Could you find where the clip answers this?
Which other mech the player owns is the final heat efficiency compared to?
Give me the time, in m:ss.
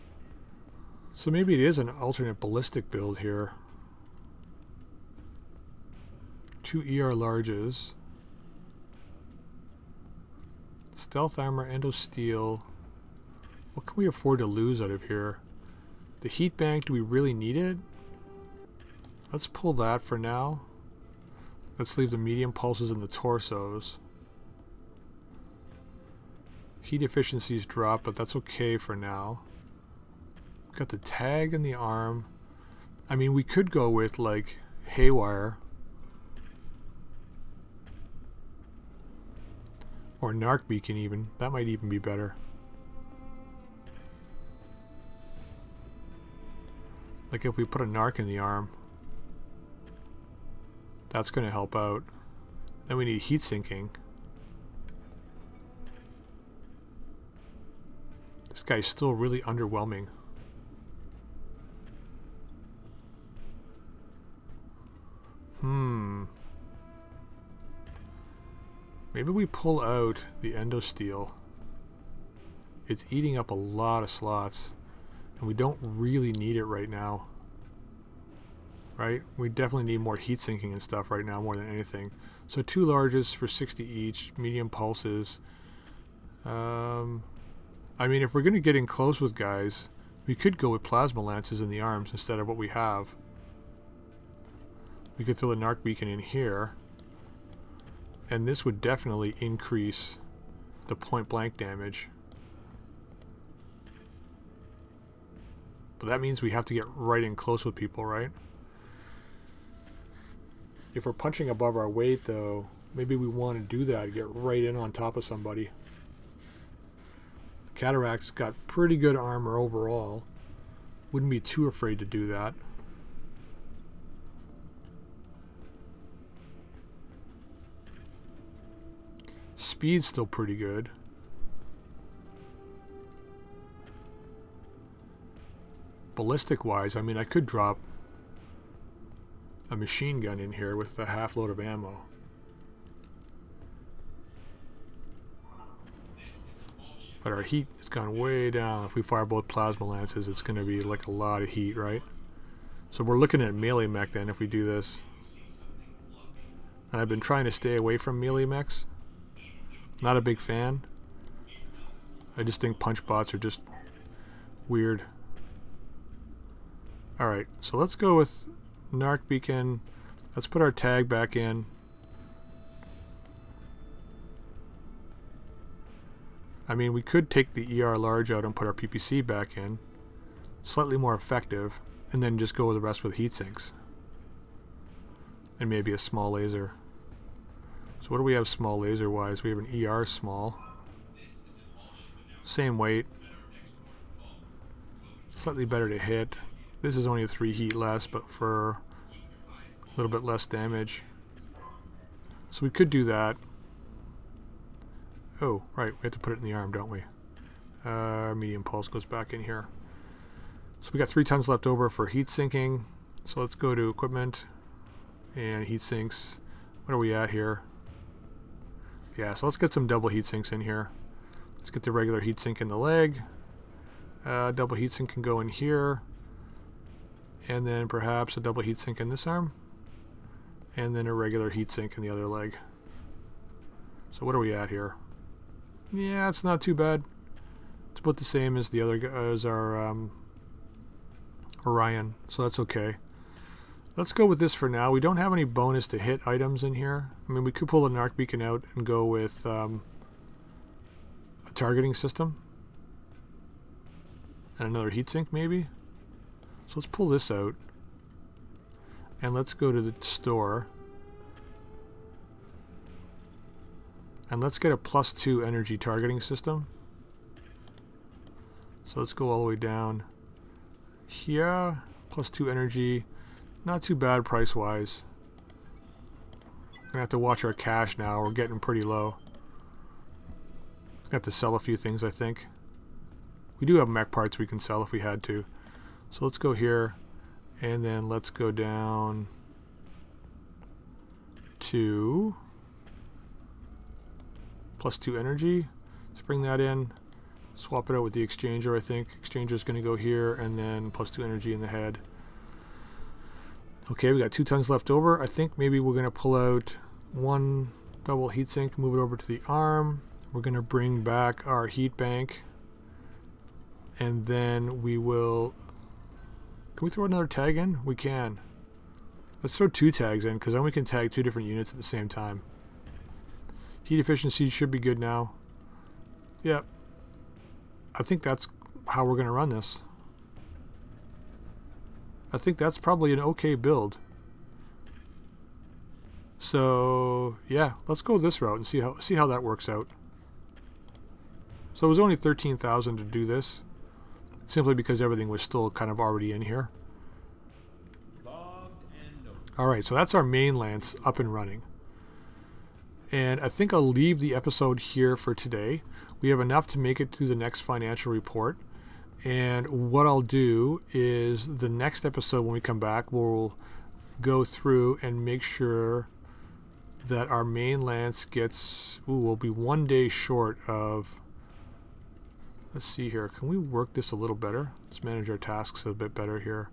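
4:01.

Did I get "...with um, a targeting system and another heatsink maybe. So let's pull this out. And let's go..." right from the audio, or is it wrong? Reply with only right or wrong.
right.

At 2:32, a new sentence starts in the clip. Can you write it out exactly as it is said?
So we're looking at melee mech then if we do this.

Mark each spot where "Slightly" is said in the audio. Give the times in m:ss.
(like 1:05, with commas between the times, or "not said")
3:00, 3:15.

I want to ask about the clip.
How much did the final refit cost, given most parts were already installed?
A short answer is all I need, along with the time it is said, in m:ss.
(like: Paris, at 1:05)
13,000, at 5:42.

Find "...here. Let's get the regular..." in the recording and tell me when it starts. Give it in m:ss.
3:40.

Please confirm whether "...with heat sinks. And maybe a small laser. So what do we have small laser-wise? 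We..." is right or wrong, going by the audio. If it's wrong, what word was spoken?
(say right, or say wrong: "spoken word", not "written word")
right.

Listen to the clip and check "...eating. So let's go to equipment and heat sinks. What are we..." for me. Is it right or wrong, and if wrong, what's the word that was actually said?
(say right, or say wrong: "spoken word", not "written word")
wrong: "sinking", not "eating".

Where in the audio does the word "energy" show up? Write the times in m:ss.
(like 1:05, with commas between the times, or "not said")
4:25, 4:32, 4:55, 5:01.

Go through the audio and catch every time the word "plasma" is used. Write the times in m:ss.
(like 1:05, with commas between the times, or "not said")
1:30, 2:29.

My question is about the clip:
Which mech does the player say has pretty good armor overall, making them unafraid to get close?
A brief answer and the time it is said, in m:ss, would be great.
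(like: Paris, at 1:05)
Cataphract, at 1:57.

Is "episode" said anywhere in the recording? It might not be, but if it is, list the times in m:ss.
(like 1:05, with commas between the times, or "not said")
5:54, 6:02.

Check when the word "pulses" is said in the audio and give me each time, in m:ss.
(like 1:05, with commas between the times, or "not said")
0:22, 1:24, 3:28.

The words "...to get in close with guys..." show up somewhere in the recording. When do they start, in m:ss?
1:28.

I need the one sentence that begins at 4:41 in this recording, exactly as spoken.
Got to sell a few things, I think.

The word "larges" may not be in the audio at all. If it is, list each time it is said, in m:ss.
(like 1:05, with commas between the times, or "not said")
0:07, 1:22, 2:57.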